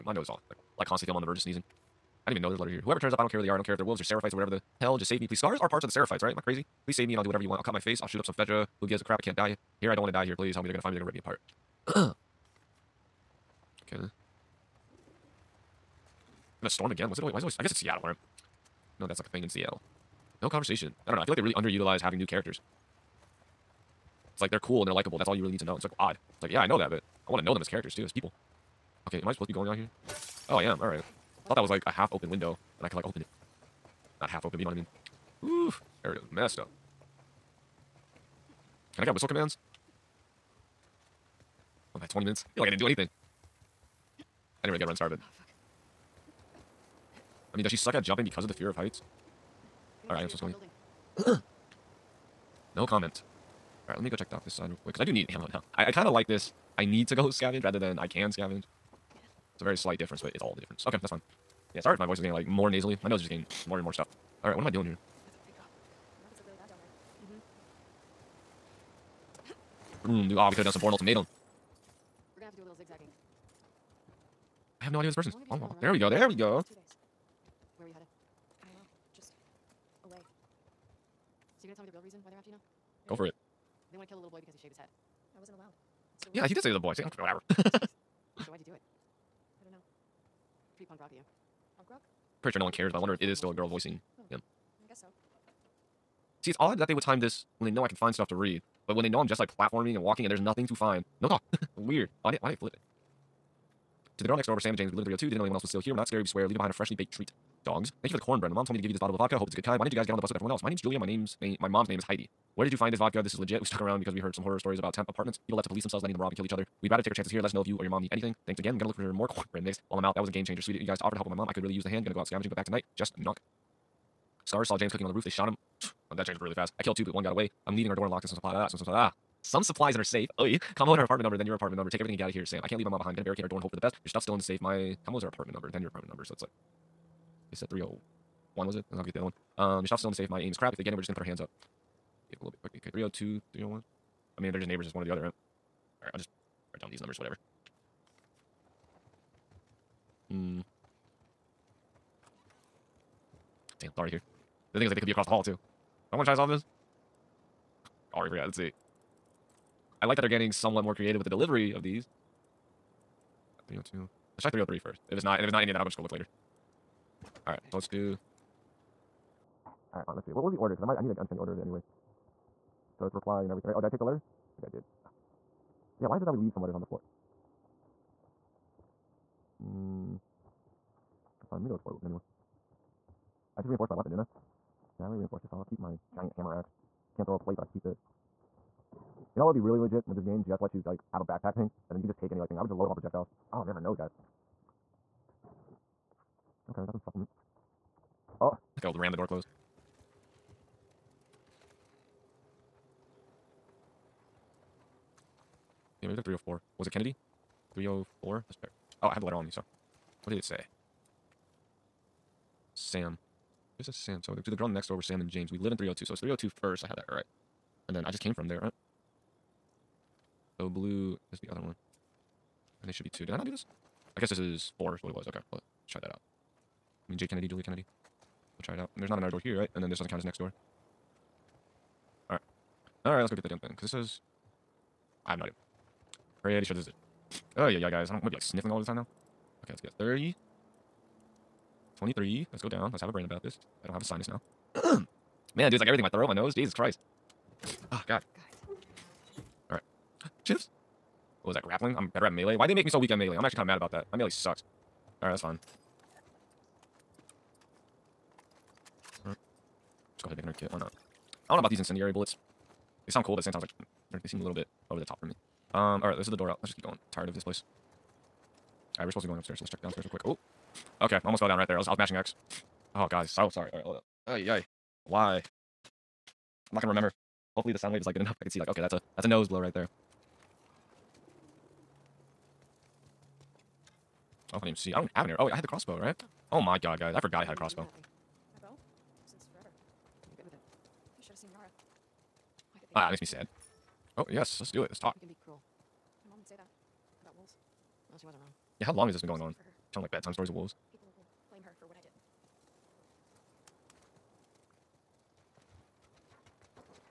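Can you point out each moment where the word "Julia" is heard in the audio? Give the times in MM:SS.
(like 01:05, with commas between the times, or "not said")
01:50, 03:47.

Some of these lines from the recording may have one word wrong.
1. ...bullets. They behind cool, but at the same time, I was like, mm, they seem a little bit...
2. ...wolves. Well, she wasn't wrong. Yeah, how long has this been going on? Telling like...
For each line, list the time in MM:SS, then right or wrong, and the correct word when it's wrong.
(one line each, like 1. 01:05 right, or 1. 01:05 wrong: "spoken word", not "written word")
1. 04:22 wrong: "sound", not "behind"
2. 04:57 right.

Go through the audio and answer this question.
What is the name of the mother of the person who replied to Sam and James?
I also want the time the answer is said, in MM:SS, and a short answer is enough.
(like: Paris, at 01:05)
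Heidi, at 01:51.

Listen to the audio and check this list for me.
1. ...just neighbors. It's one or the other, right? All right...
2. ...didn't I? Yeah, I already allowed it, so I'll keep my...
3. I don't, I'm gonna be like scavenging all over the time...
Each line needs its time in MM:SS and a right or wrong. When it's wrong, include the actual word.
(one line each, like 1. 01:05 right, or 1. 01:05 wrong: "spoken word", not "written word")
1. 02:24 right
2. 03:04 wrong: "reinforced", not "allowed"
3. 03:58 wrong: "sniffling", not "scavenging".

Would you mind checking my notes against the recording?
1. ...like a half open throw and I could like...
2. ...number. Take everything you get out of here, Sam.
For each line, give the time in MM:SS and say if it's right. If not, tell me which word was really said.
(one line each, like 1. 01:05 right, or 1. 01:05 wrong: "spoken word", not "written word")
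1. 00:31 wrong: "window", not "throw"
2. 02:11 right.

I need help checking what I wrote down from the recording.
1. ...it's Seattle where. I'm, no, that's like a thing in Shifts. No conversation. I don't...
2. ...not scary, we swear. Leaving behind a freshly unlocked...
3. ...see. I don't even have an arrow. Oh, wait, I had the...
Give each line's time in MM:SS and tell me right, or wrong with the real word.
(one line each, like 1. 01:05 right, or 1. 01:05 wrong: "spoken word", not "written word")
1. 00:17 wrong: "Seattle", not "Shifts"
2. 01:45 wrong: "baked", not "unlocked"
3. 04:44 right.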